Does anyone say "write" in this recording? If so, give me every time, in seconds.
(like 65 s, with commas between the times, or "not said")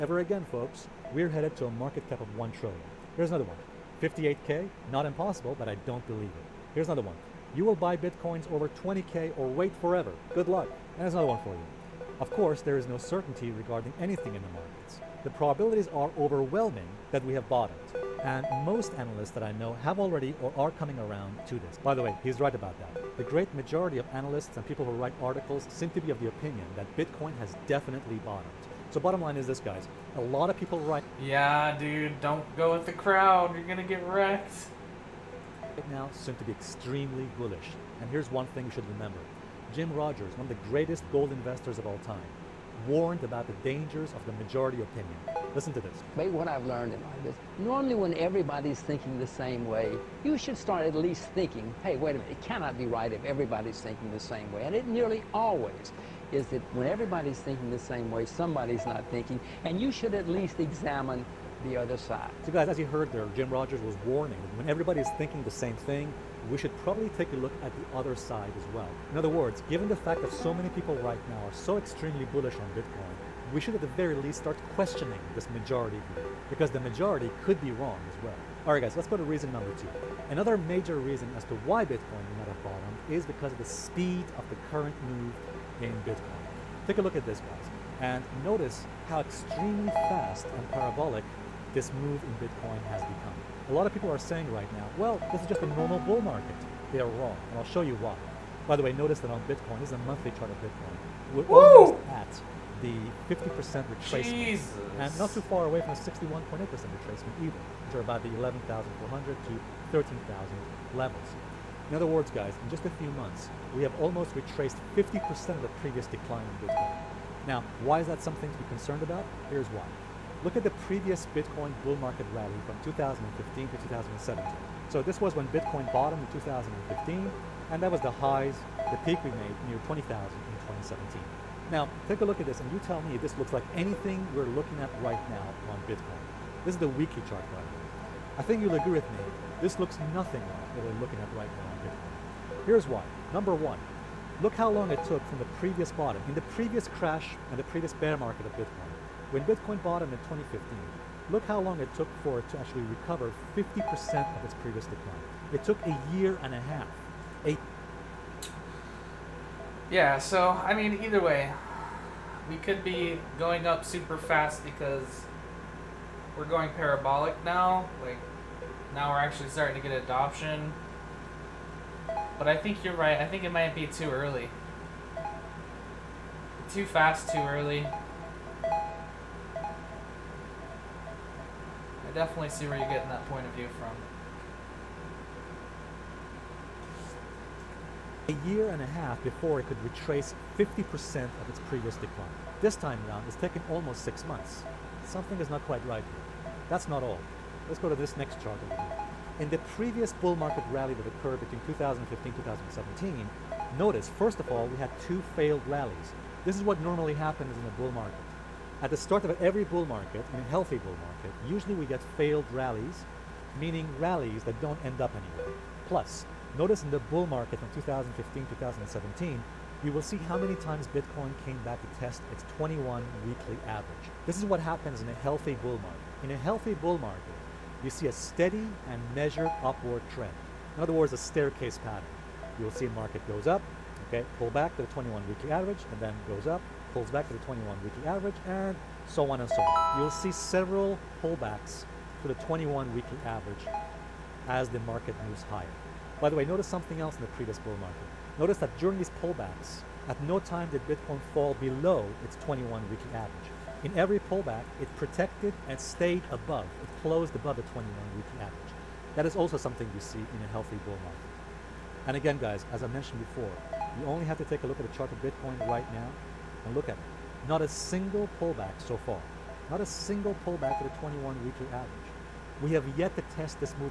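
24 s, 30 s.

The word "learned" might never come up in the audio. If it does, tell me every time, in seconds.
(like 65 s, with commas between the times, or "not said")
46 s.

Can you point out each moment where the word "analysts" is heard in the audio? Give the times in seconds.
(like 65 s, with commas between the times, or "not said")
18 s, 24 s.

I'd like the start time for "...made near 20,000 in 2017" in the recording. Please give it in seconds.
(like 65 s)
129 s.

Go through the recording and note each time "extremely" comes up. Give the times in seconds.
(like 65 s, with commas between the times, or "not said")
36 s, 71 s, 89 s.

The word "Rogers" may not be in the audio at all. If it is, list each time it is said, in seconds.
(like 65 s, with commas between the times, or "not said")
39 s, 63 s.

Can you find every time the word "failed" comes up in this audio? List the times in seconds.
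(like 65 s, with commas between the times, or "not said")
205 s, 212 s.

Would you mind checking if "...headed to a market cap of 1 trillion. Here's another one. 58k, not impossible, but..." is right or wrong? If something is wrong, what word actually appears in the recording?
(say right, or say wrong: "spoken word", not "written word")
right.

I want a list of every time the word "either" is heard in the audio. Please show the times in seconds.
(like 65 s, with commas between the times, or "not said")
107 s, 161 s.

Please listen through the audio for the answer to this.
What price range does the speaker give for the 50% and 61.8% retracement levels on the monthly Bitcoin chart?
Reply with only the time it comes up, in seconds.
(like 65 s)
108 s.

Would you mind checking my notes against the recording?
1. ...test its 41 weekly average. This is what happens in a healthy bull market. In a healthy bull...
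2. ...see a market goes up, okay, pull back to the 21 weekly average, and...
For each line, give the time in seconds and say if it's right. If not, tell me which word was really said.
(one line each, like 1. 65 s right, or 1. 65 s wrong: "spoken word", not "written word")
1. 221 s wrong: "21", not "41"
2. 232 s right.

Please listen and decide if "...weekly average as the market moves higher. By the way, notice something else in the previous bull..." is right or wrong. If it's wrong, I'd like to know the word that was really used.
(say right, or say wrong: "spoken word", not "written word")
right.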